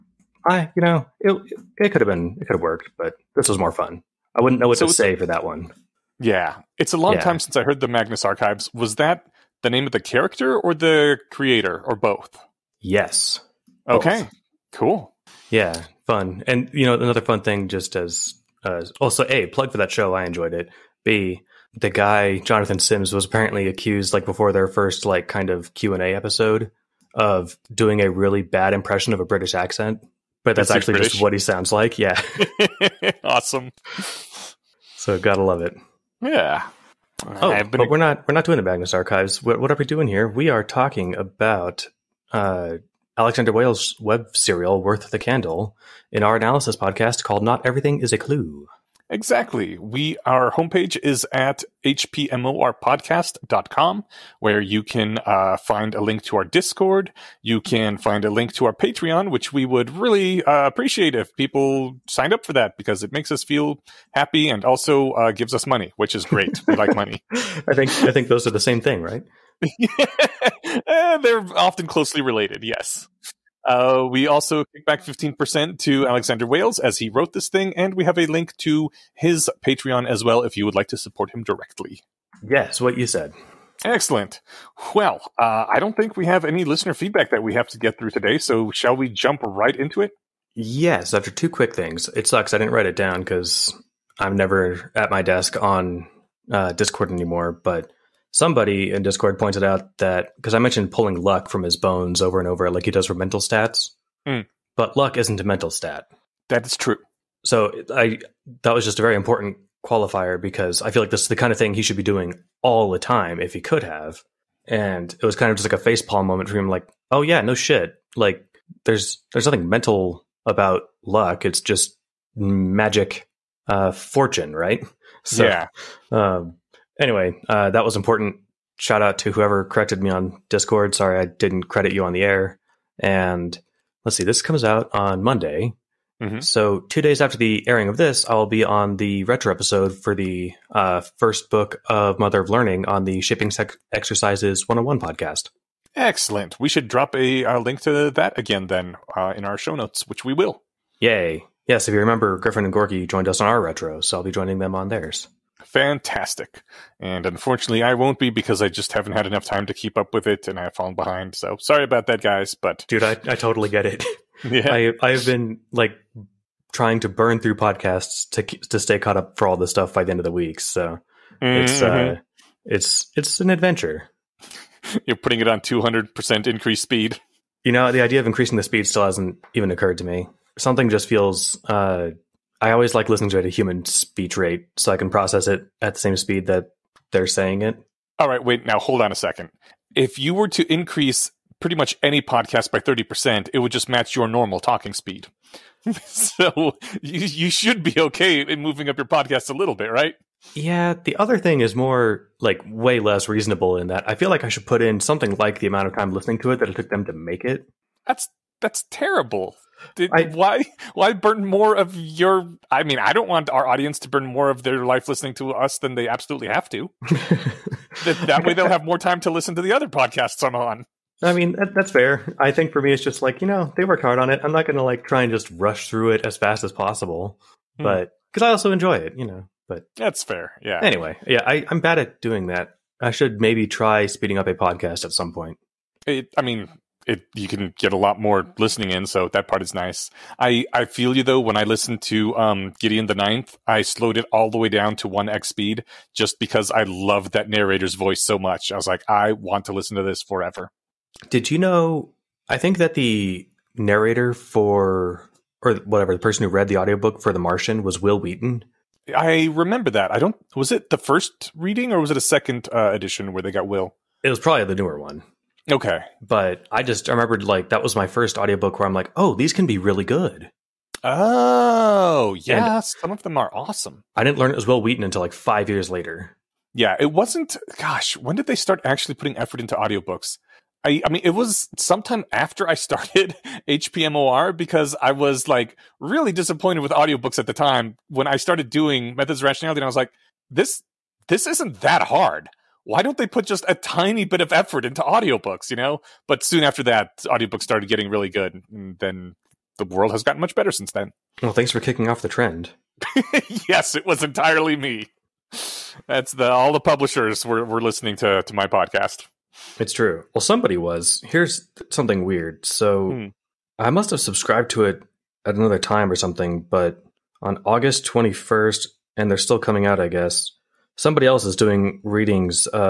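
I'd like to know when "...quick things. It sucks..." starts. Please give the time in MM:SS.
01:31.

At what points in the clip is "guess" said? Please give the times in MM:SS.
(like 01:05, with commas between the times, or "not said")
05:20.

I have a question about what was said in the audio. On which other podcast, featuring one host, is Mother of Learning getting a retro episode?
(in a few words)
Shipping Sec- Exercises 101.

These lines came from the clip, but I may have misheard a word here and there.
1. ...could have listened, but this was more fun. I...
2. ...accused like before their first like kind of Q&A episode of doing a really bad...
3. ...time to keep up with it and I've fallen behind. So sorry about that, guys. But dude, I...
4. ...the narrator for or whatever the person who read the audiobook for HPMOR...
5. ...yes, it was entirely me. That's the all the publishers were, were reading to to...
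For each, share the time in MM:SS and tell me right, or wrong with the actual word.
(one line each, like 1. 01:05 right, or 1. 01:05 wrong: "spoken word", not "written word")
1. 00:02 wrong: "worked", not "listened"
2. 00:23 right
3. 02:39 right
4. 04:12 wrong: "The", not "HPMOR"
5. 05:03 wrong: "listening", not "reading".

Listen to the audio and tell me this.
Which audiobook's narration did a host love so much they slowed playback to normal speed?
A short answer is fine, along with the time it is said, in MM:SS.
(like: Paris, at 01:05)
Gideon the Ninth, at 04:02.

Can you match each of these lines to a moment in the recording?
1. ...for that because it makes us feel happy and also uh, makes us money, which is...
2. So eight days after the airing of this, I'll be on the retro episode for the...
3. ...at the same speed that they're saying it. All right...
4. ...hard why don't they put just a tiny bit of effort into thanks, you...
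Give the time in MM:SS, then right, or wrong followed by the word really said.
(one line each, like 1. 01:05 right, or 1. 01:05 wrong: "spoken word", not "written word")
1. 01:02 wrong: "gives", not "makes"
2. 02:16 wrong: "two", not "eight"
3. 03:05 right
4. 04:52 wrong: "audiobooks", not "thanks".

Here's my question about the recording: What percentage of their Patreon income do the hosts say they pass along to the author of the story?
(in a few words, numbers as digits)
15%.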